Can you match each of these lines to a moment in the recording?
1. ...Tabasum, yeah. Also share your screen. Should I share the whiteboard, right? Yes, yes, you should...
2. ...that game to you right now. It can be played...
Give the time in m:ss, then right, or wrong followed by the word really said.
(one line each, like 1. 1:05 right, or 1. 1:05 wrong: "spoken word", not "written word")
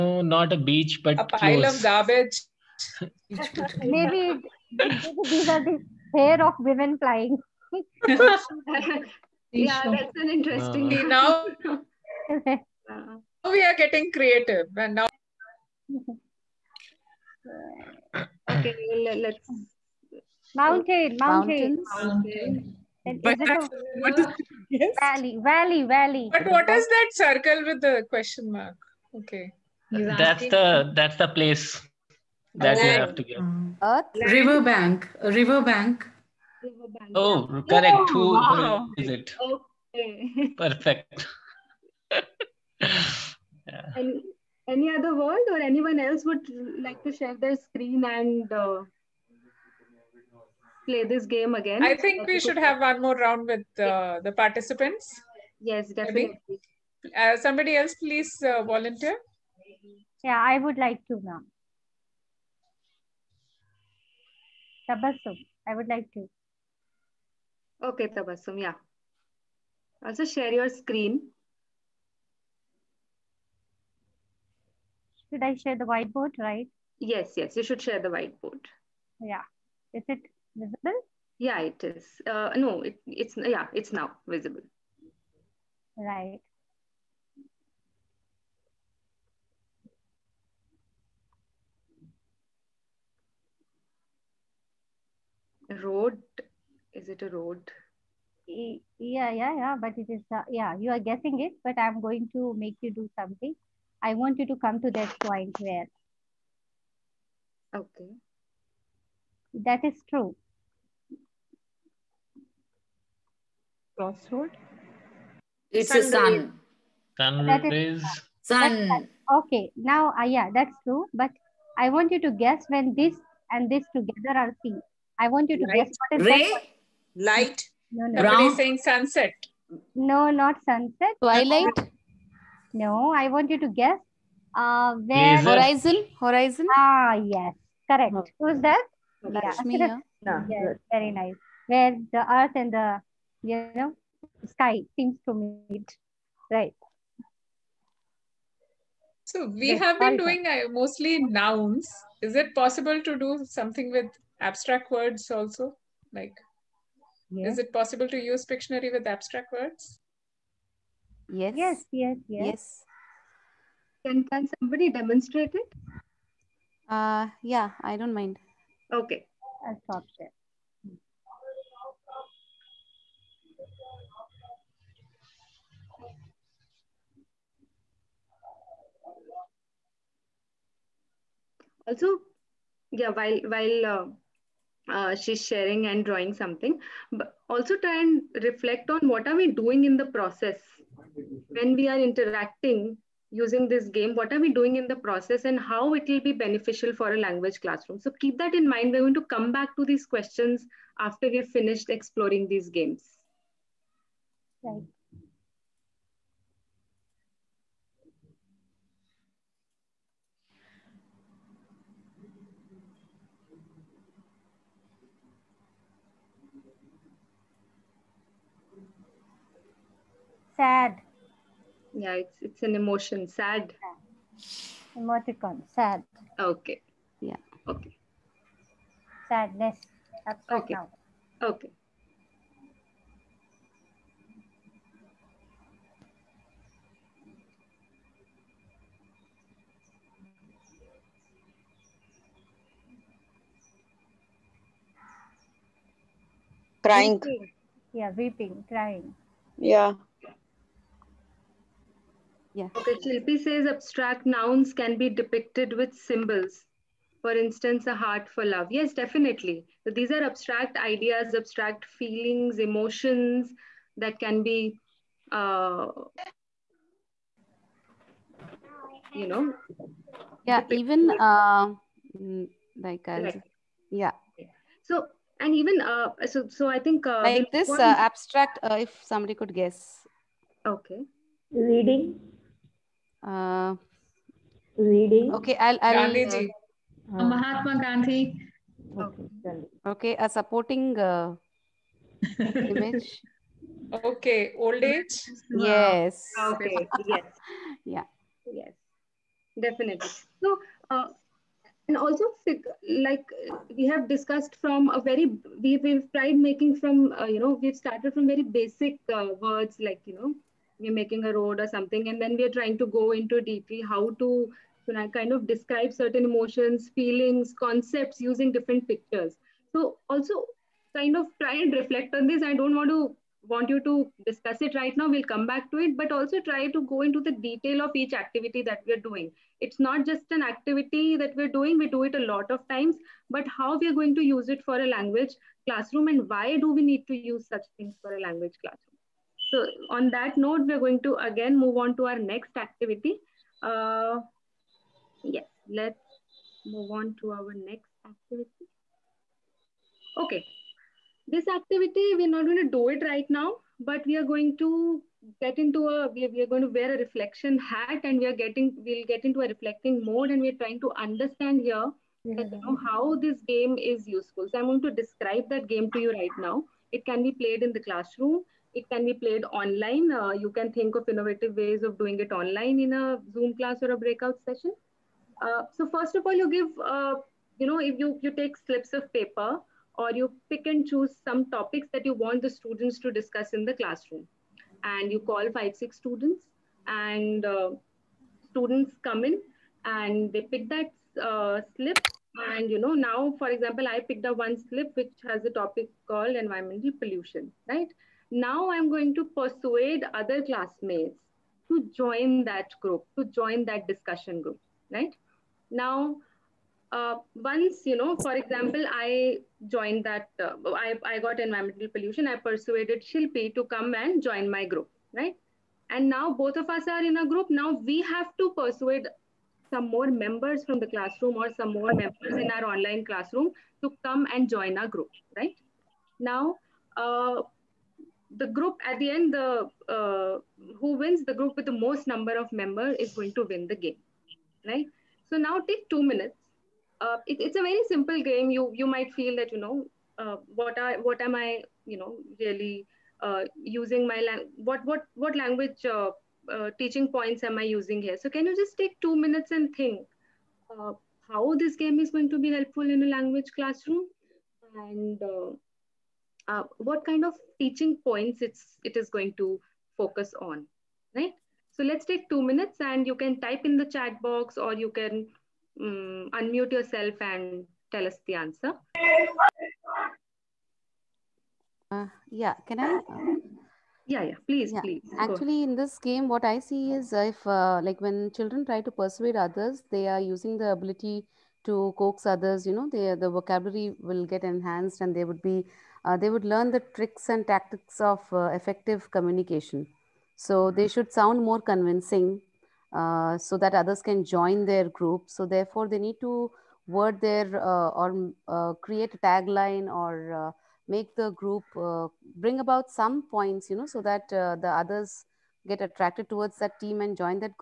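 1. 1:08 right
2. 6:05 right.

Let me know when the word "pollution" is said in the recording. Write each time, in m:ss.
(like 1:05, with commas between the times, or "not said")
6:36, 6:51.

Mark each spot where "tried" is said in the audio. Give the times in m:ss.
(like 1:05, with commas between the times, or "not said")
5:06.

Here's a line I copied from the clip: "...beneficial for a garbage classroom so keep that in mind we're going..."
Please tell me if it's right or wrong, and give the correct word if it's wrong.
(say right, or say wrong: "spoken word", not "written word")
wrong: "language", not "garbage".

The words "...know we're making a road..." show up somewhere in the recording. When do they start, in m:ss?
5:10.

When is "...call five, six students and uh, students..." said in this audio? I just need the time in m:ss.
6:25.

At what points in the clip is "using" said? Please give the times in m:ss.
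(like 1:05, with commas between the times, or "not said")
3:13, 5:18, 7:23, 7:27, 8:00.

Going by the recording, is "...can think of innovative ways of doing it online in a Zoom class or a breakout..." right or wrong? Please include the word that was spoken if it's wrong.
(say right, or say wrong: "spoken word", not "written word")
right.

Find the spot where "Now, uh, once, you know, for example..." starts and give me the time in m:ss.
6:45.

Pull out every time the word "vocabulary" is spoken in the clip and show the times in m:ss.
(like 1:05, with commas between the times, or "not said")
8:03.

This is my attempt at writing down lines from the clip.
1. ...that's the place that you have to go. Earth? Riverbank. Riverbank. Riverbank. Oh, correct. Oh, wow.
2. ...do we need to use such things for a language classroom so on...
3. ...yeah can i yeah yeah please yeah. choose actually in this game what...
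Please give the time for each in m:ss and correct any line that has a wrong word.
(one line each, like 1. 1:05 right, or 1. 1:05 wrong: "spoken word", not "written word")
1. 0:30 right
2. 5:36 right
3. 7:52 wrong: "please", not "choose".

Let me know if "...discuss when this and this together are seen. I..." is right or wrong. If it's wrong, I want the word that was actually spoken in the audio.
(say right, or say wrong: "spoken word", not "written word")
wrong: "guess", not "discuss".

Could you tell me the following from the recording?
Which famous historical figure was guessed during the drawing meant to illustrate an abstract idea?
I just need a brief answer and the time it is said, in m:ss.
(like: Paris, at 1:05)
Mahatma Gandhi, at 4:47.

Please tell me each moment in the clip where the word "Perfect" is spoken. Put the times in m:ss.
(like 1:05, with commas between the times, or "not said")
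0:40.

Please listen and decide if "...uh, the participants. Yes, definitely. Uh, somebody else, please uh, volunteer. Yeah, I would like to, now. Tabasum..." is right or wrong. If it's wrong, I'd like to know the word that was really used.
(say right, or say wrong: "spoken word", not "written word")
right.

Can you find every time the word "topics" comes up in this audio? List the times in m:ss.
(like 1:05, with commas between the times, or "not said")
6:21, 6:35.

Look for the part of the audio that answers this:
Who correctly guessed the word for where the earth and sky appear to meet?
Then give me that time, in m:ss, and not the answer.
2:19.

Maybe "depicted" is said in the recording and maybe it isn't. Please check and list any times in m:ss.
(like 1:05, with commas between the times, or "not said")
4:15, 4:30.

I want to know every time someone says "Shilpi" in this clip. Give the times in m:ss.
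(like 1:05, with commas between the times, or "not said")
4:13, 6:53.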